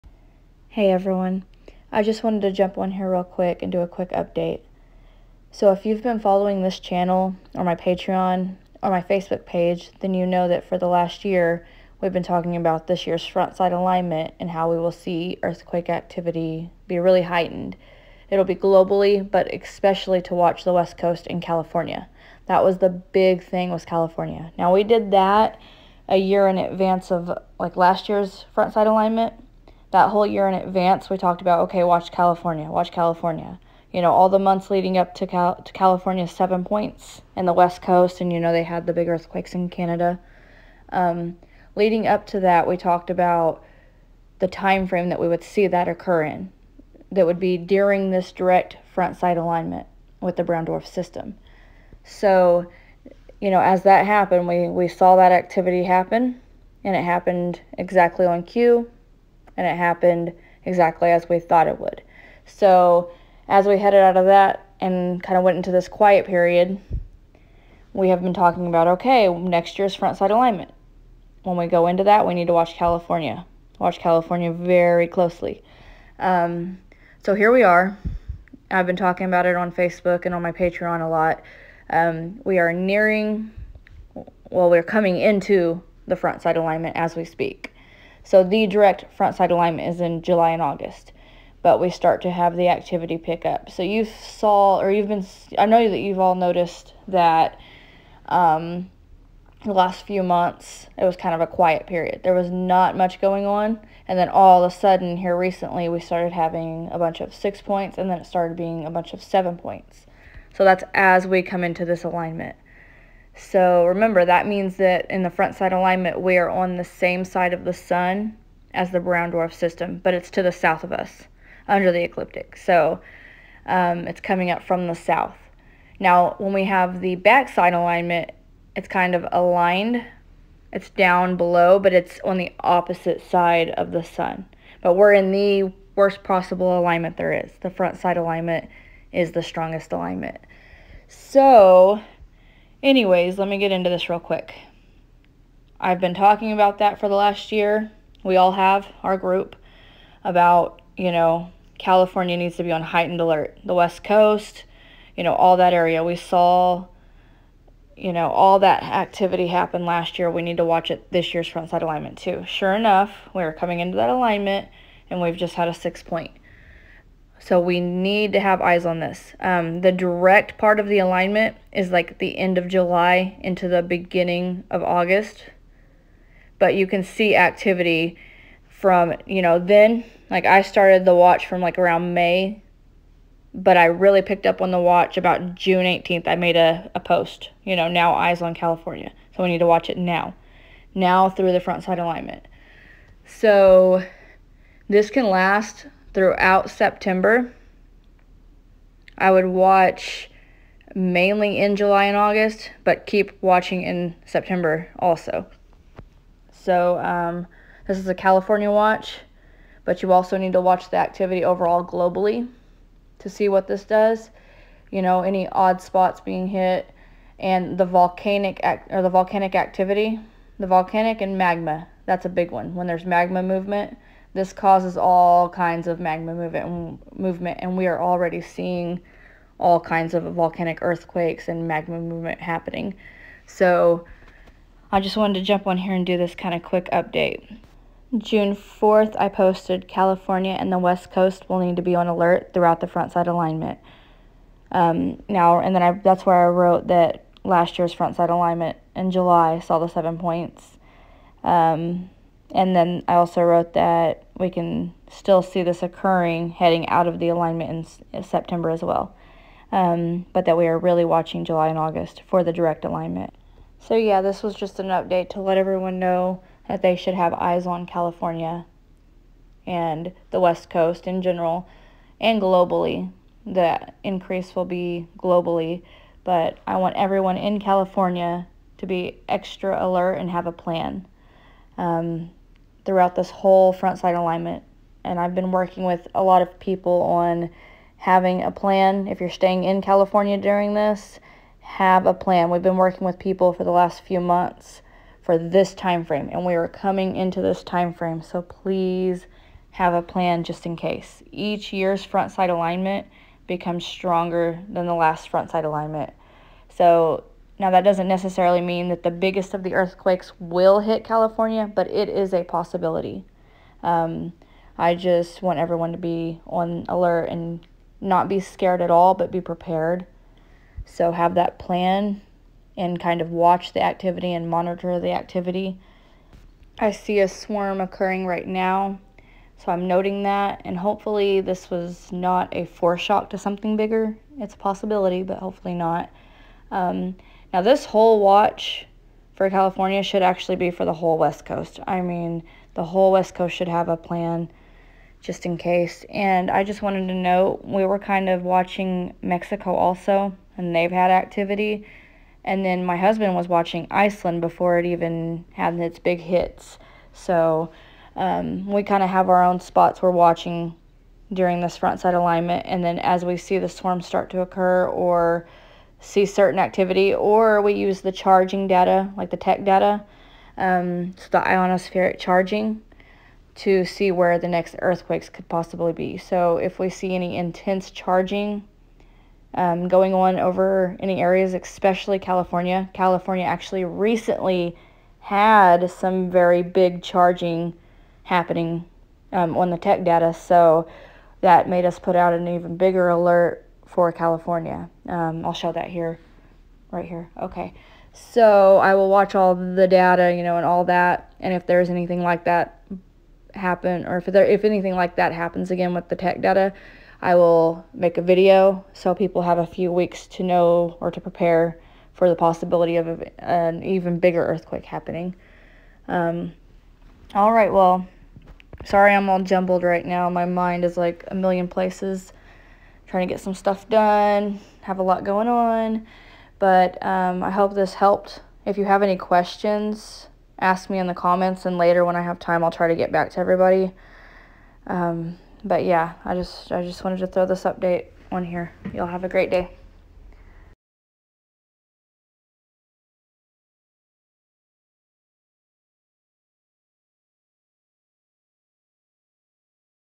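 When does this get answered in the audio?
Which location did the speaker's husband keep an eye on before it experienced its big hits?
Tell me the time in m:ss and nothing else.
5:53.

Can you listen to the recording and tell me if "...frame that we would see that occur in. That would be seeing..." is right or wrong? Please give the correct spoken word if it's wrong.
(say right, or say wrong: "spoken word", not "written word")
wrong: "during", not "seeing".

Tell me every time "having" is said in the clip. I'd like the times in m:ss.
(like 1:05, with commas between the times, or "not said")
1:46, 4:47.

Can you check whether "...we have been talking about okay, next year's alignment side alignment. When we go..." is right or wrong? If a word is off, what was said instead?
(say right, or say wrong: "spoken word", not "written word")
wrong: "front", not "alignment".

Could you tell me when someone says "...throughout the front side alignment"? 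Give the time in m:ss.
4:02.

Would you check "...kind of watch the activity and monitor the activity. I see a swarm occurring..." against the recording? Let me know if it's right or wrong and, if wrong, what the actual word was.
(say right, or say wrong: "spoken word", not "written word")
right.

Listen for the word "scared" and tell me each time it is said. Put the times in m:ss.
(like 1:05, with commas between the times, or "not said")
5:18.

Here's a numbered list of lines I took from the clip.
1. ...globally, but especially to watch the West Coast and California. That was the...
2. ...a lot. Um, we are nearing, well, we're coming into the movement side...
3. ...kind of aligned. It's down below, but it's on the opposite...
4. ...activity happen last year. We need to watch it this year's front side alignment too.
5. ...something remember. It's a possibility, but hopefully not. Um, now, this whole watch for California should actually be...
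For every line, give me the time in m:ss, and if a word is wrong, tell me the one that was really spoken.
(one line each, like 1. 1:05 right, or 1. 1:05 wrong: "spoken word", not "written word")
1. 0:18 right
2. 1:21 wrong: "front", not "movement"
3. 2:08 right
4. 2:38 right
5. 5:33 wrong: "bigger", not "remember".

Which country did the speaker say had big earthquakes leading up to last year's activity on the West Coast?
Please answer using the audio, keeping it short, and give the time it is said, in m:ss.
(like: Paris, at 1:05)
Canada, at 0:39.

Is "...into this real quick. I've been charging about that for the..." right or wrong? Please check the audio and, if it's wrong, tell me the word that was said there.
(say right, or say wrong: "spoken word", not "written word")
wrong: "talking", not "charging".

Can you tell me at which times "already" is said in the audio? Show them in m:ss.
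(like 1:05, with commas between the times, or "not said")
3:48.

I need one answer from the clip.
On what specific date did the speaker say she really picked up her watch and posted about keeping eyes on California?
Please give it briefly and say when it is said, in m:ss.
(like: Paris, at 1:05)
June 18, at 3:05.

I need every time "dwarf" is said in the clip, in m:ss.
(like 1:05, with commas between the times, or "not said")
0:50, 1:59.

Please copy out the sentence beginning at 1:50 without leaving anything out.
So that's as we come into this alignment.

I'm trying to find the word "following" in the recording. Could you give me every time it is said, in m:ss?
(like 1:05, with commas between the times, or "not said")
0:06.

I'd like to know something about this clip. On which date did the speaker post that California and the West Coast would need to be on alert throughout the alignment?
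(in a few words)
June 4.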